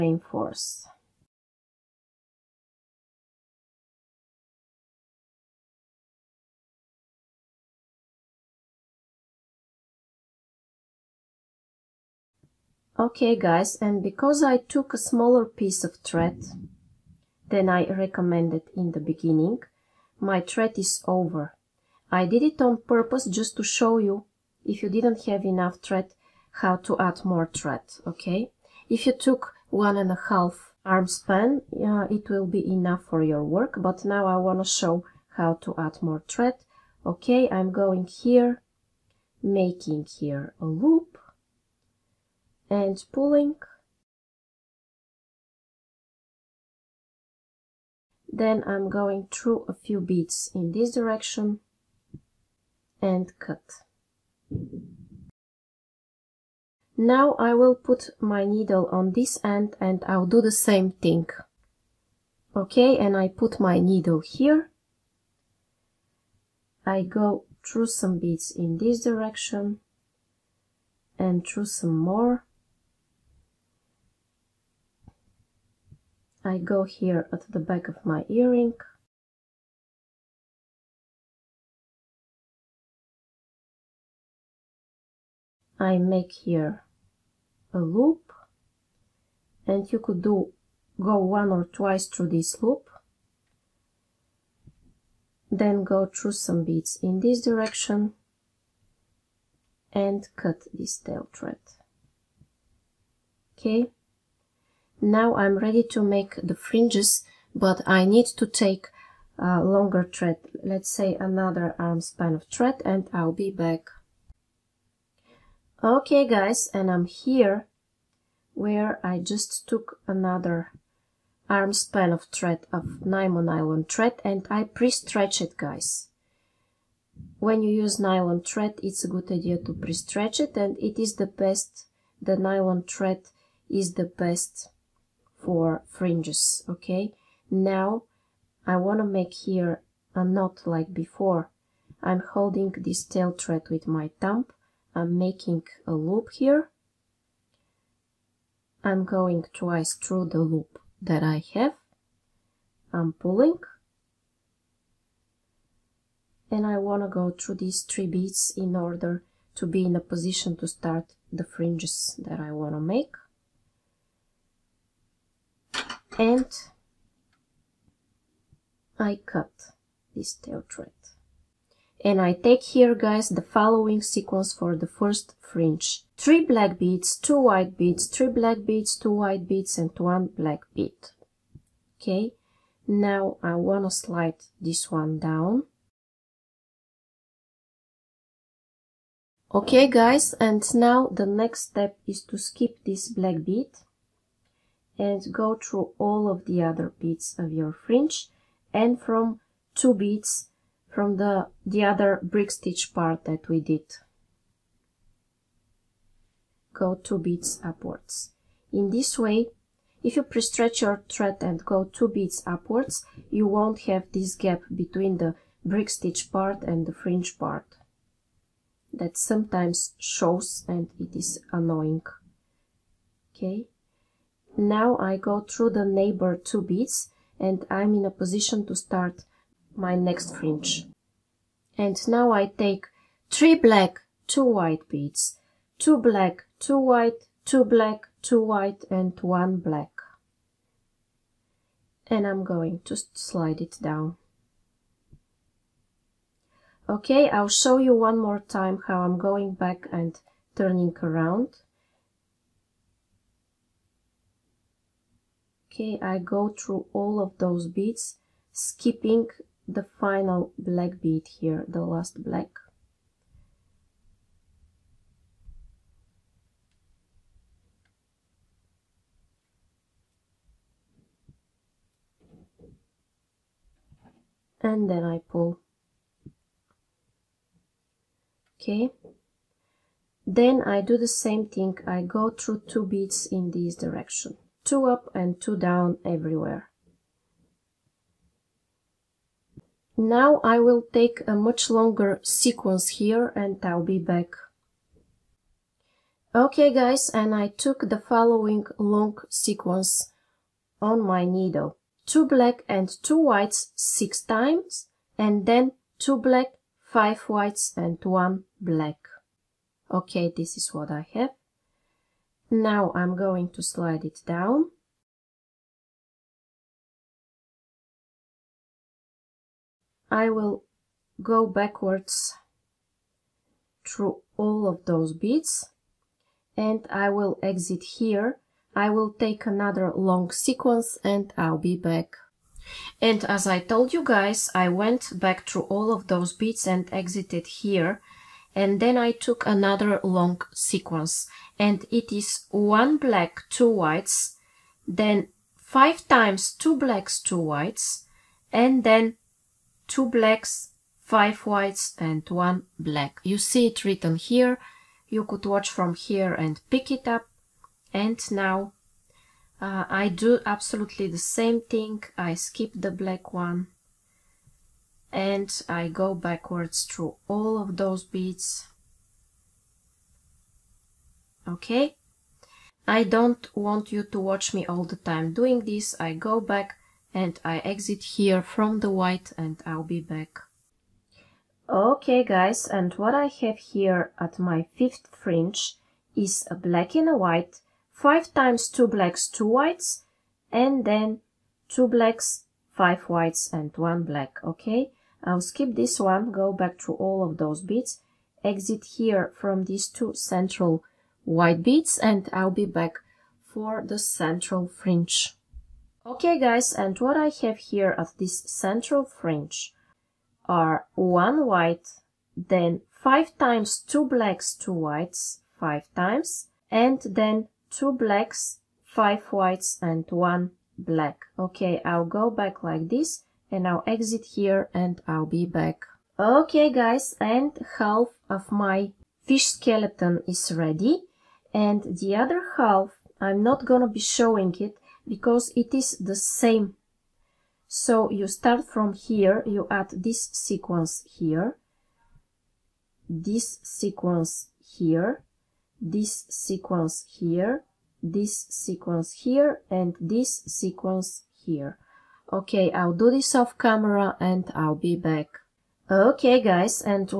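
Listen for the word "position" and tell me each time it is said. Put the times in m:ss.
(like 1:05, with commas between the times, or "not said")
2:40, 3:48.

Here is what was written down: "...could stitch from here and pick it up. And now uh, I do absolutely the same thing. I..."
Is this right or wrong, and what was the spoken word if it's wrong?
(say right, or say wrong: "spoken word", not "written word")
wrong: "watch", not "stitch".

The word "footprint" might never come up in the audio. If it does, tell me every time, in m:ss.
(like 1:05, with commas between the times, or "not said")
not said.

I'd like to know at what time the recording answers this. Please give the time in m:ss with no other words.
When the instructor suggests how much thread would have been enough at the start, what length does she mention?
0:29.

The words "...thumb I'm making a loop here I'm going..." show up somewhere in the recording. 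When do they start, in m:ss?
2:24.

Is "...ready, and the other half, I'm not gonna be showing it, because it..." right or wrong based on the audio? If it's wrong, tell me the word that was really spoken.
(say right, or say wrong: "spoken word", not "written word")
right.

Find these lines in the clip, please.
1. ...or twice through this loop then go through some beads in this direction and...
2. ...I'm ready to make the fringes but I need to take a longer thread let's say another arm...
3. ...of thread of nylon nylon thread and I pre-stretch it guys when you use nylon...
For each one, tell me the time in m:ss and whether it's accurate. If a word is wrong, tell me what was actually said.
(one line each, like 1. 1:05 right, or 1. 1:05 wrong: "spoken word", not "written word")
1. 1:31 right
2. 1:45 right
3. 2:02 right.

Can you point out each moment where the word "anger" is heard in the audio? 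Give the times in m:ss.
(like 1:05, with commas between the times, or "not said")
not said.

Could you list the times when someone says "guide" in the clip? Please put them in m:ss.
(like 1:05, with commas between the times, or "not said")
not said.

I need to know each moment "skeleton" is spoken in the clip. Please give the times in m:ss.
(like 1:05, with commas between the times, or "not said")
7:09.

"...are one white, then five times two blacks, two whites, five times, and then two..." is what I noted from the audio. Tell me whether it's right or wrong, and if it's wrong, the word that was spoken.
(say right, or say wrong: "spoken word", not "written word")
right.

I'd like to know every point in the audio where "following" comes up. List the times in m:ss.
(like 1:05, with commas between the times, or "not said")
2:53, 4:57.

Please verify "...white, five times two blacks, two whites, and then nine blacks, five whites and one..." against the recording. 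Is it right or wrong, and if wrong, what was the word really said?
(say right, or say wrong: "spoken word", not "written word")
wrong: "two", not "nine".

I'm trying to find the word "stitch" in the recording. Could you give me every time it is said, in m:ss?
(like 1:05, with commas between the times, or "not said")
3:22, 3:35.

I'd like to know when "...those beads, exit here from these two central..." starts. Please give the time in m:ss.
6:37.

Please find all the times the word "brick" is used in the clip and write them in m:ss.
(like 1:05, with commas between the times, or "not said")
3:22, 3:35.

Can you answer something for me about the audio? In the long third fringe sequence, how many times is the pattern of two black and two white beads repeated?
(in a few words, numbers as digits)
6.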